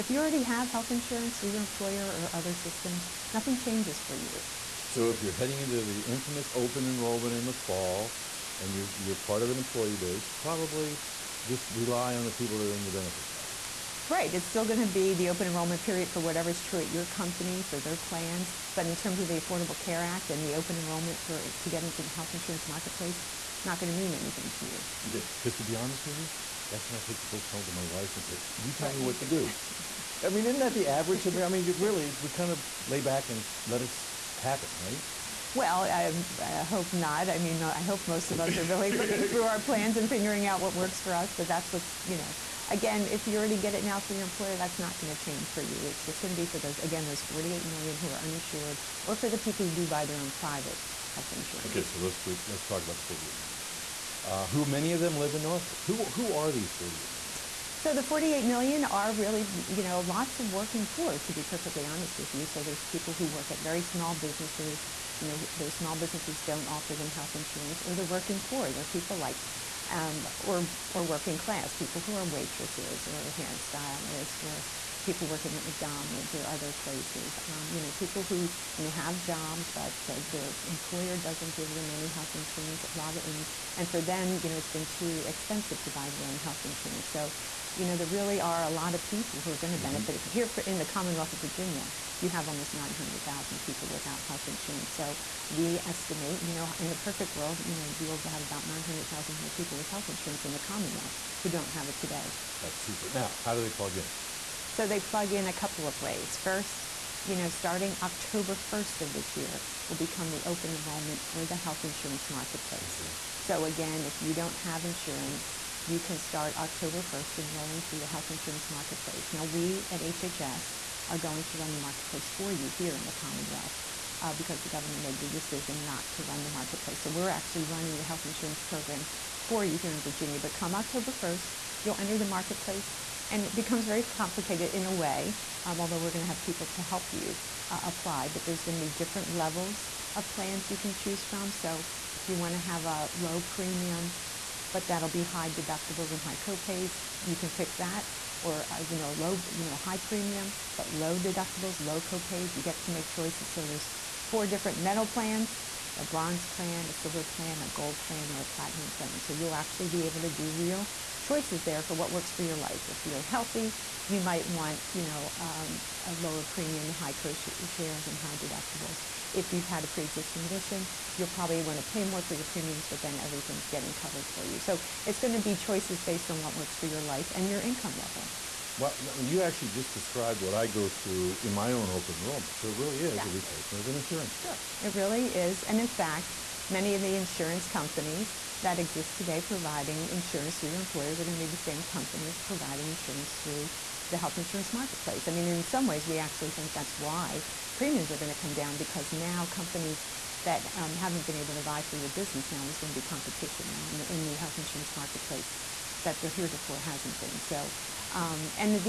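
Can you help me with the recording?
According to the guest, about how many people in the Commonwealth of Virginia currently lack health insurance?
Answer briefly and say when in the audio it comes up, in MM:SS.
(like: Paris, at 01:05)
900,000, at 01:32.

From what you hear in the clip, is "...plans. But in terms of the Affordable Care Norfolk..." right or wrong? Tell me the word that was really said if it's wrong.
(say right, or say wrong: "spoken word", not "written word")
wrong: "Act", not "Norfolk".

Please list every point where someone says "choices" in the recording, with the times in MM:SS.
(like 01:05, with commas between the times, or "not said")
02:33, 02:41, 02:55.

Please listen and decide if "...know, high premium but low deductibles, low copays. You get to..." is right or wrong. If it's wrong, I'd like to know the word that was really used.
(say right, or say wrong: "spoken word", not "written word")
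right.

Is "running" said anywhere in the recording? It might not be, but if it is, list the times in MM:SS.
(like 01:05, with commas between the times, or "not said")
02:07.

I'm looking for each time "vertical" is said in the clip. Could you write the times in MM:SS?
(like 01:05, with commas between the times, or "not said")
not said.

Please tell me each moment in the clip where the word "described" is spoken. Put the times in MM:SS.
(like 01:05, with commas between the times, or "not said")
02:59.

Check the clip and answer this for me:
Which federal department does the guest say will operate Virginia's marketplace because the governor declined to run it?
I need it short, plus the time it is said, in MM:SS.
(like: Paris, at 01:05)
HHS, at 02:00.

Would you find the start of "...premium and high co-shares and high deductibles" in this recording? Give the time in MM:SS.
02:46.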